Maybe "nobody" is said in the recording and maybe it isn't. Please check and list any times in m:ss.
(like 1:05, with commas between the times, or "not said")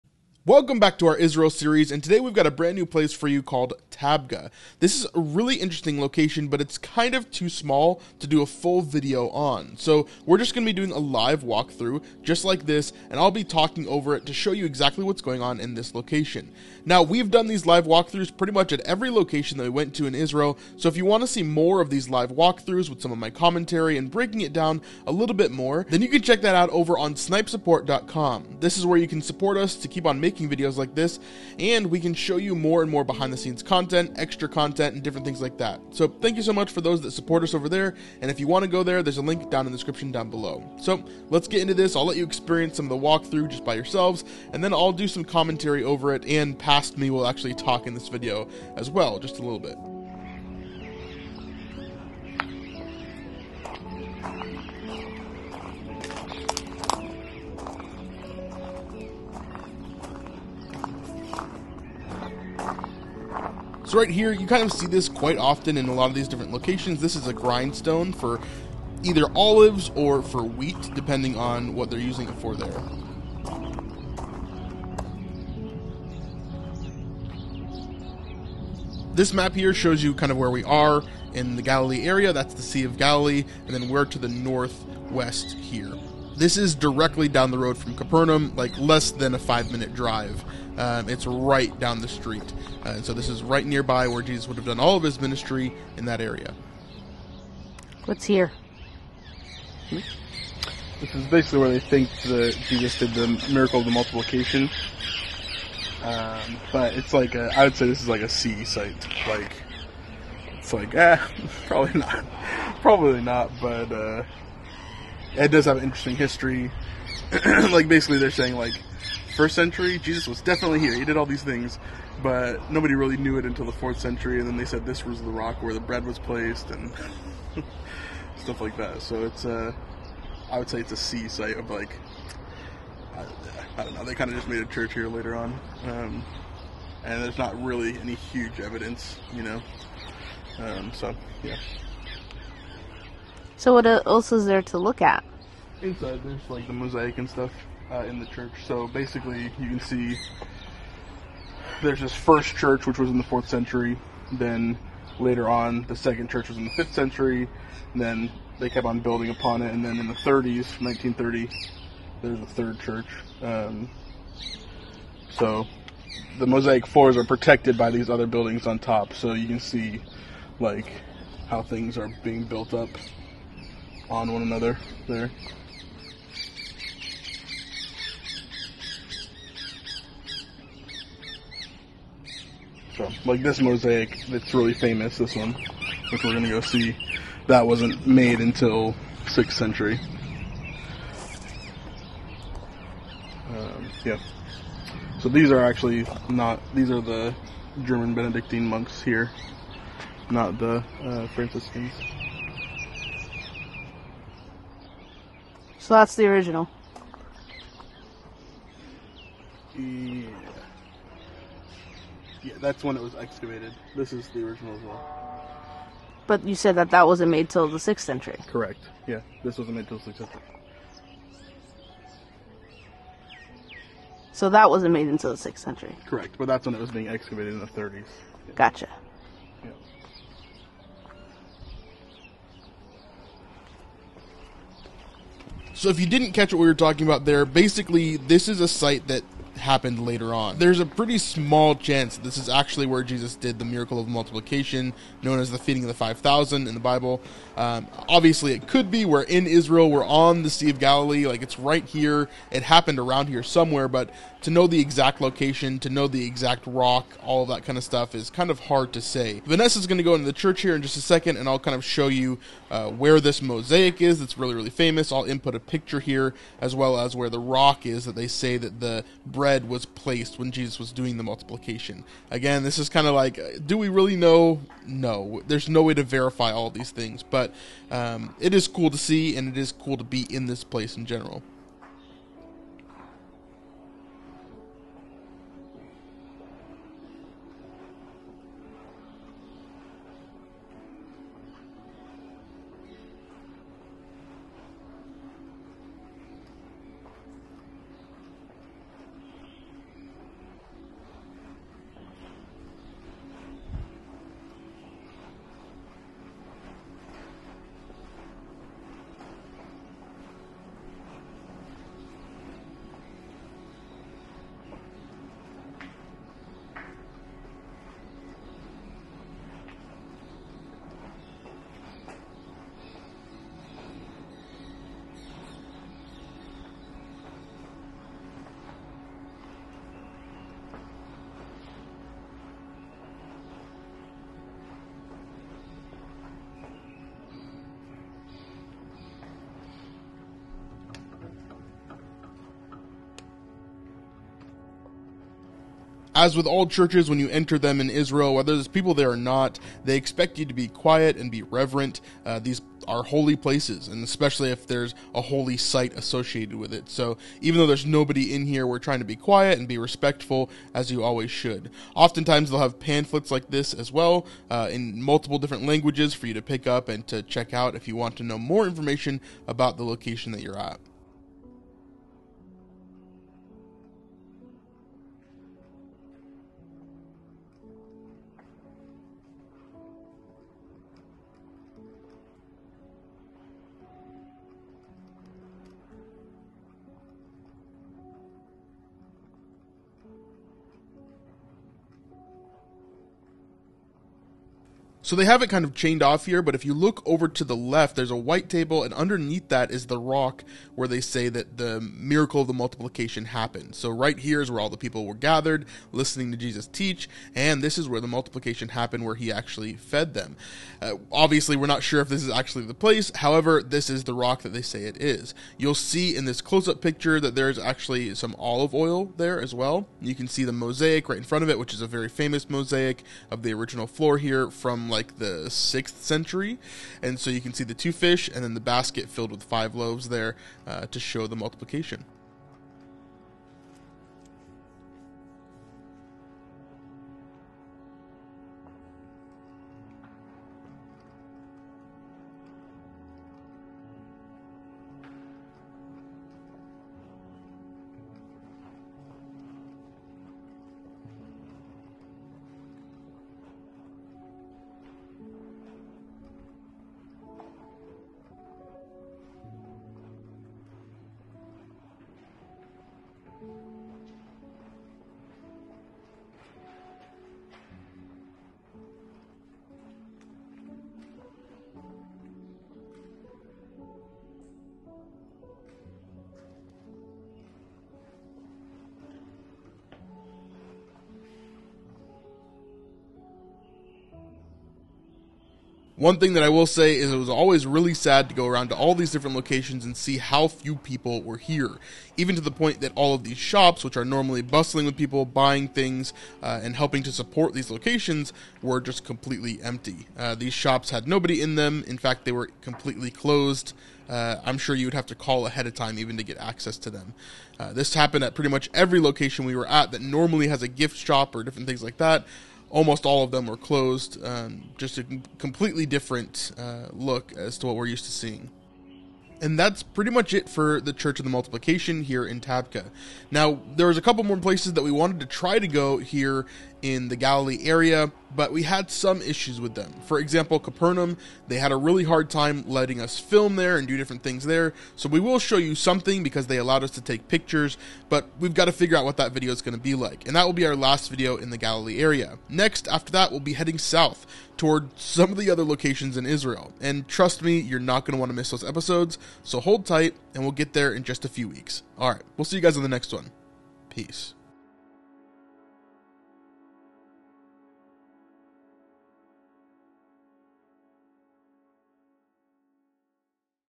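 2:02, 5:57, 8:21.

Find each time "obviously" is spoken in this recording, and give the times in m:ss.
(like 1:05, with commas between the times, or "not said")
4:08, 6:51.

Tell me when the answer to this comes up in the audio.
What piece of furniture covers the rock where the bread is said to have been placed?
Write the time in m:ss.
6:38.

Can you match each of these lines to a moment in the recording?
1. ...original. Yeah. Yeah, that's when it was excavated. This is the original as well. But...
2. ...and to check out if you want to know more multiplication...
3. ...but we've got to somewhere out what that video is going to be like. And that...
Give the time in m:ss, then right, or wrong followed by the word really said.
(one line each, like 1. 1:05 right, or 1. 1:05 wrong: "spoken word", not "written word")
1. 3:26 right
2. 6:06 wrong: "information", not "multiplication"
3. 8:58 wrong: "figure", not "somewhere".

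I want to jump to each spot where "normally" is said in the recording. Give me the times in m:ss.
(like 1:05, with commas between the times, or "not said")
8:14, 8:30.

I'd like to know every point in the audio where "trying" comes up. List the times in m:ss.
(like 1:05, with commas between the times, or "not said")
5:58.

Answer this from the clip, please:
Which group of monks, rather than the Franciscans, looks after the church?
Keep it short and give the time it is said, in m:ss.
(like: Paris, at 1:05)
German Benedictine monks, at 3:17.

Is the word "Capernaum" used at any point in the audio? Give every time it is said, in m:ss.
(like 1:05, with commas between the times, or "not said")
1:27, 8:50.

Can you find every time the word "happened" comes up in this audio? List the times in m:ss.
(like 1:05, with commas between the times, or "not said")
3:59, 4:12, 6:43, 6:48, 8:27.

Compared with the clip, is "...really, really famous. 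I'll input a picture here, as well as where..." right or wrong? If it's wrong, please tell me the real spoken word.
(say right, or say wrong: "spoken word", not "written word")
right.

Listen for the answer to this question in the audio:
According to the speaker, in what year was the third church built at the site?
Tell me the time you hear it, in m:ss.
2:40.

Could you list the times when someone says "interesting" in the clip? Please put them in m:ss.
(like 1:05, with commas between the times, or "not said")
0:05, 1:55.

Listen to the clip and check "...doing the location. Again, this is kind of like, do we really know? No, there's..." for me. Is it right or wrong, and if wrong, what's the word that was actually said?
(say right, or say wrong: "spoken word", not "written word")
wrong: "multiplication", not "location".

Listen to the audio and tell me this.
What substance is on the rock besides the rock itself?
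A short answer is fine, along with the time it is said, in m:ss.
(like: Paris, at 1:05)
Olive oil, at 6:58.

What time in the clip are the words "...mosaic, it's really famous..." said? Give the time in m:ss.
3:03.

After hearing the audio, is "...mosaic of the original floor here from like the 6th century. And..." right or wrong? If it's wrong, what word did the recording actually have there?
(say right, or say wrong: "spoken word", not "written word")
right.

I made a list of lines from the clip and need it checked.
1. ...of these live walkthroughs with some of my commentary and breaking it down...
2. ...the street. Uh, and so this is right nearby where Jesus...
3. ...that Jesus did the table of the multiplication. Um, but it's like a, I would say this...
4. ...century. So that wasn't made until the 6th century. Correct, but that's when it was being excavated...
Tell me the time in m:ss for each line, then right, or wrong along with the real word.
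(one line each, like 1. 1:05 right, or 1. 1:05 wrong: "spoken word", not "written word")
1. 0:21 right
2. 1:32 right
3. 1:42 wrong: "miracle", not "table"
4. 3:40 right.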